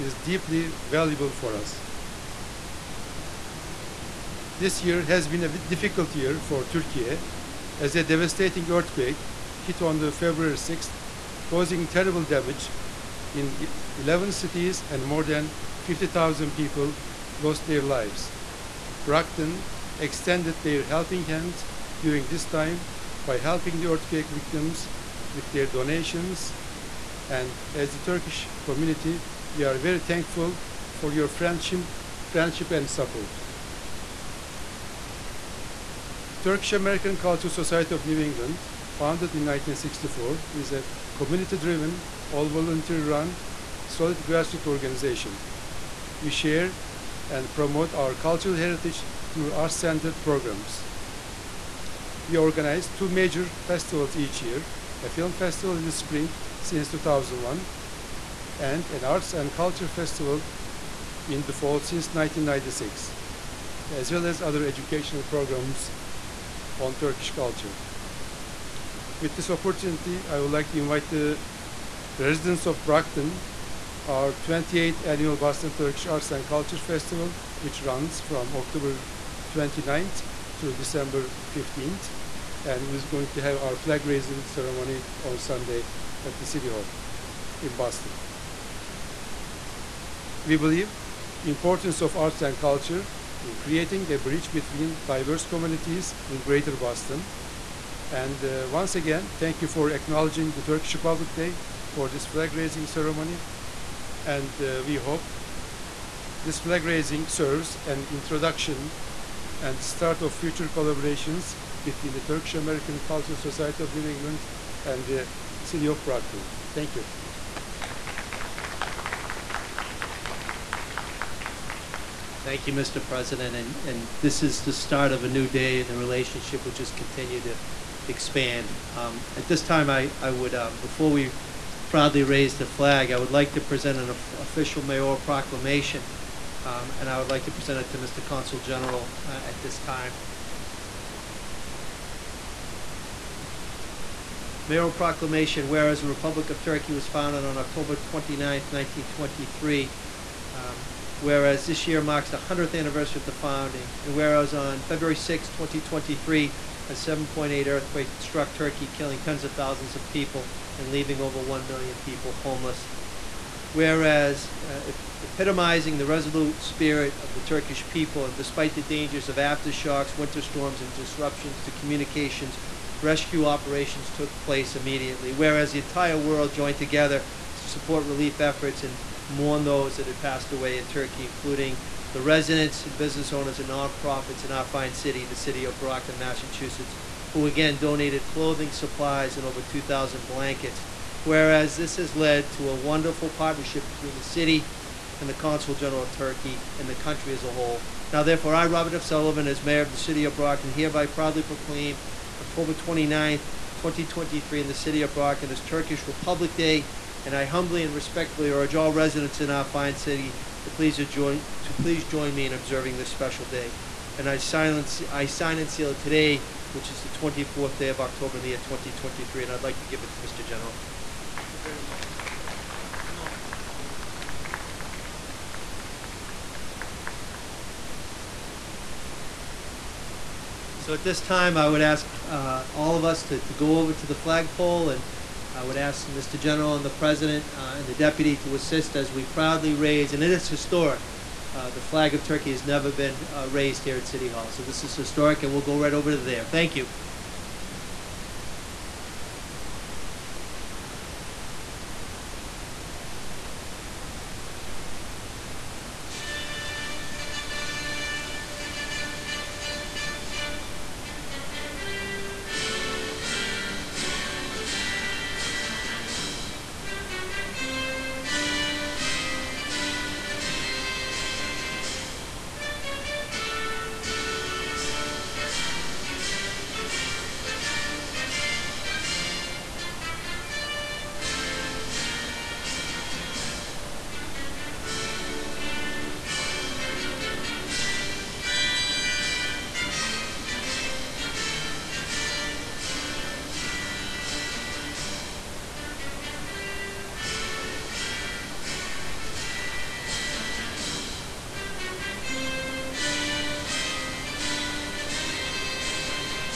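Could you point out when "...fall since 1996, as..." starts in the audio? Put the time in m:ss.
1:01.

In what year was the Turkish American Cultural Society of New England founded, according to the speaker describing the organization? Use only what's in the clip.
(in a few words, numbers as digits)
1964.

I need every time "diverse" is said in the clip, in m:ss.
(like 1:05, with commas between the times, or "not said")
1:35.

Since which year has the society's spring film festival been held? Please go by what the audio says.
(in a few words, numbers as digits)
2001.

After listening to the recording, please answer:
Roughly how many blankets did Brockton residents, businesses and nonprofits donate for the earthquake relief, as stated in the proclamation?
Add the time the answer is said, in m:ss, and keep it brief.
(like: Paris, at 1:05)
over 2,000, at 3:09.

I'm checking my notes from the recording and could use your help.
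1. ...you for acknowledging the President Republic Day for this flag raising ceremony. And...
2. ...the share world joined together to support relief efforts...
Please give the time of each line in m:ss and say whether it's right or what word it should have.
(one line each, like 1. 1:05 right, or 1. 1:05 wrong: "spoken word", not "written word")
1. 1:39 wrong: "Turkish", not "President"
2. 2:55 wrong: "entire", not "share".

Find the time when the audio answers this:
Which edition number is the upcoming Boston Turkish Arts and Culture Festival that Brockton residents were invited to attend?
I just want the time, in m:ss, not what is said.
1:14.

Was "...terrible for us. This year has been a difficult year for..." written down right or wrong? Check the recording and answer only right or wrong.
wrong.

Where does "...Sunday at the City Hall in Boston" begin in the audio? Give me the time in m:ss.
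1:25.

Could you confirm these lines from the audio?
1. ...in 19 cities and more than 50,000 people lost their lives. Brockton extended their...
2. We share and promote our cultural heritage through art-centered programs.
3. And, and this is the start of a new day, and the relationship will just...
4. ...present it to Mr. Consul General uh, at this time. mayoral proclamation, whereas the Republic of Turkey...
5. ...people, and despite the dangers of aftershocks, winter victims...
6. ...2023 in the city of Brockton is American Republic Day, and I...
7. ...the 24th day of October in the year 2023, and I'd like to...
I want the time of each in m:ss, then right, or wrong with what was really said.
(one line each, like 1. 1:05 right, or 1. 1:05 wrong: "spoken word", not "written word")
1. 0:13 wrong: "11", not "19"
2. 0:46 right
3. 2:03 right
4. 2:17 right
5. 2:47 wrong: "storms", not "victims"
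6. 3:23 wrong: "Turkish", not "American"
7. 3:37 right.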